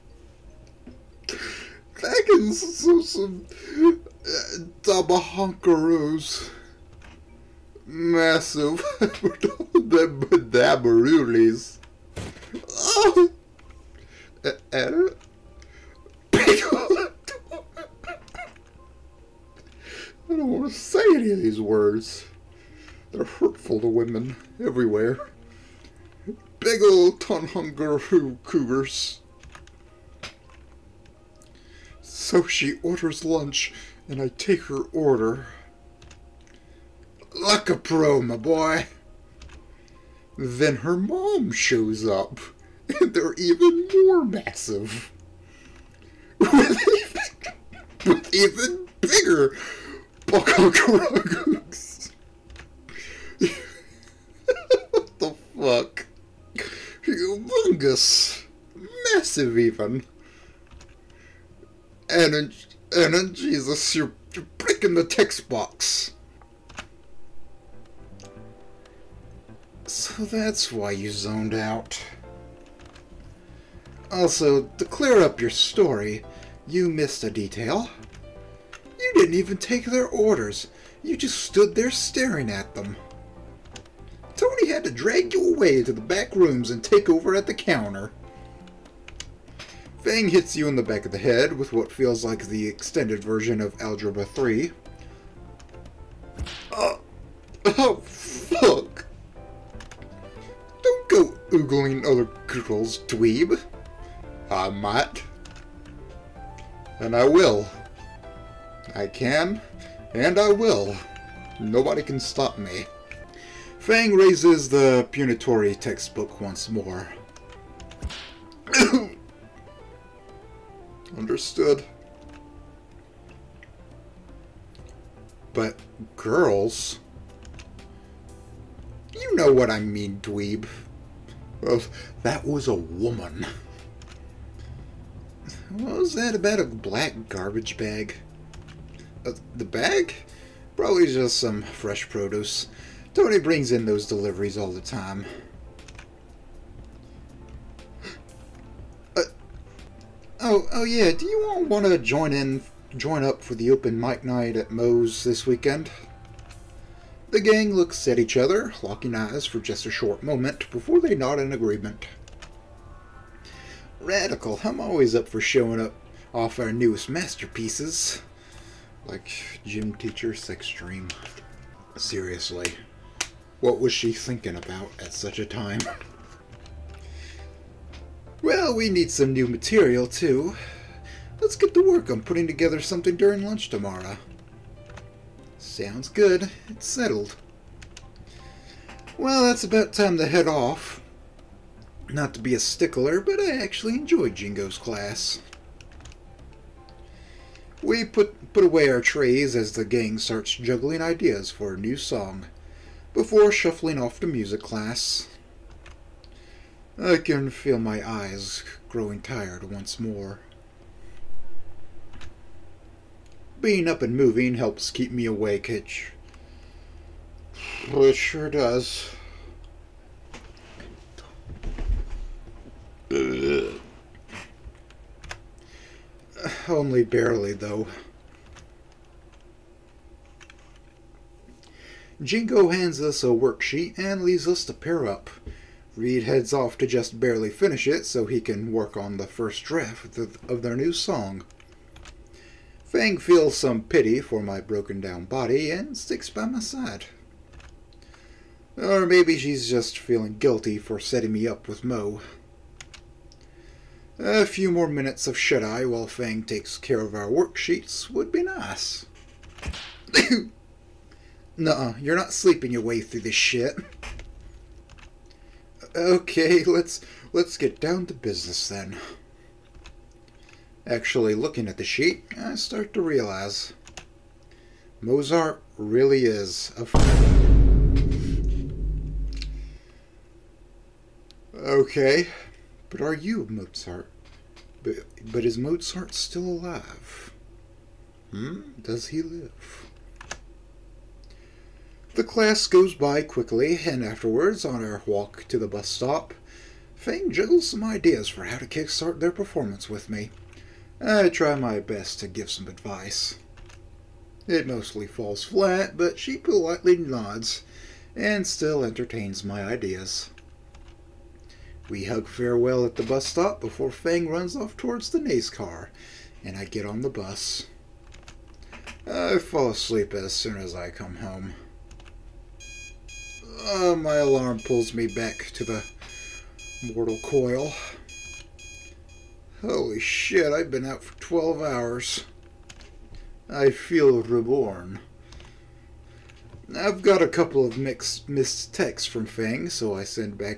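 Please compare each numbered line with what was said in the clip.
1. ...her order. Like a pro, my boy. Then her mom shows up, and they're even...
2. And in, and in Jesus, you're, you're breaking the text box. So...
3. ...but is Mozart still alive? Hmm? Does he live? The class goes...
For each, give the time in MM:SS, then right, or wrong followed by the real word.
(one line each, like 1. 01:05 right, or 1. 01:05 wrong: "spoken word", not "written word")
1. 00:34 right
2. 01:02 right
3. 04:45 right.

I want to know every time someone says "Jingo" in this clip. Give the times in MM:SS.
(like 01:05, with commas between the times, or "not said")
03:14, 03:52.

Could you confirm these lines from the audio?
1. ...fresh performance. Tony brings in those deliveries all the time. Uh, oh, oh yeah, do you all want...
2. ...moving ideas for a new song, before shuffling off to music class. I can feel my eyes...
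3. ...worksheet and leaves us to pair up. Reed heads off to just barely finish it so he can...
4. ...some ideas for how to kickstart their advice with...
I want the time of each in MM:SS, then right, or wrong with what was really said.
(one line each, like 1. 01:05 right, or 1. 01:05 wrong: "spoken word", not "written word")
1. 02:21 wrong: "produce", not "performance"
2. 03:20 wrong: "juggling", not "moving"
3. 03:53 right
4. 04:57 wrong: "performance", not "advice".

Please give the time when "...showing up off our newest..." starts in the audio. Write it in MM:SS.
02:45.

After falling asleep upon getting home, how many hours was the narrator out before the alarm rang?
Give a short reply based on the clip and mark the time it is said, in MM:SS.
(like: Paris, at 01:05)
12, at 05:31.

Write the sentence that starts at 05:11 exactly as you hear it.
We hug farewell at the bus stop before Fang runs off towards the Nace car, and I get on the bus.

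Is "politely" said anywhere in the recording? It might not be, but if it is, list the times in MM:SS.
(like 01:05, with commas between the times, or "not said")
05:06.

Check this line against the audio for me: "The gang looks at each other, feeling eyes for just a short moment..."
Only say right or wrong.
wrong.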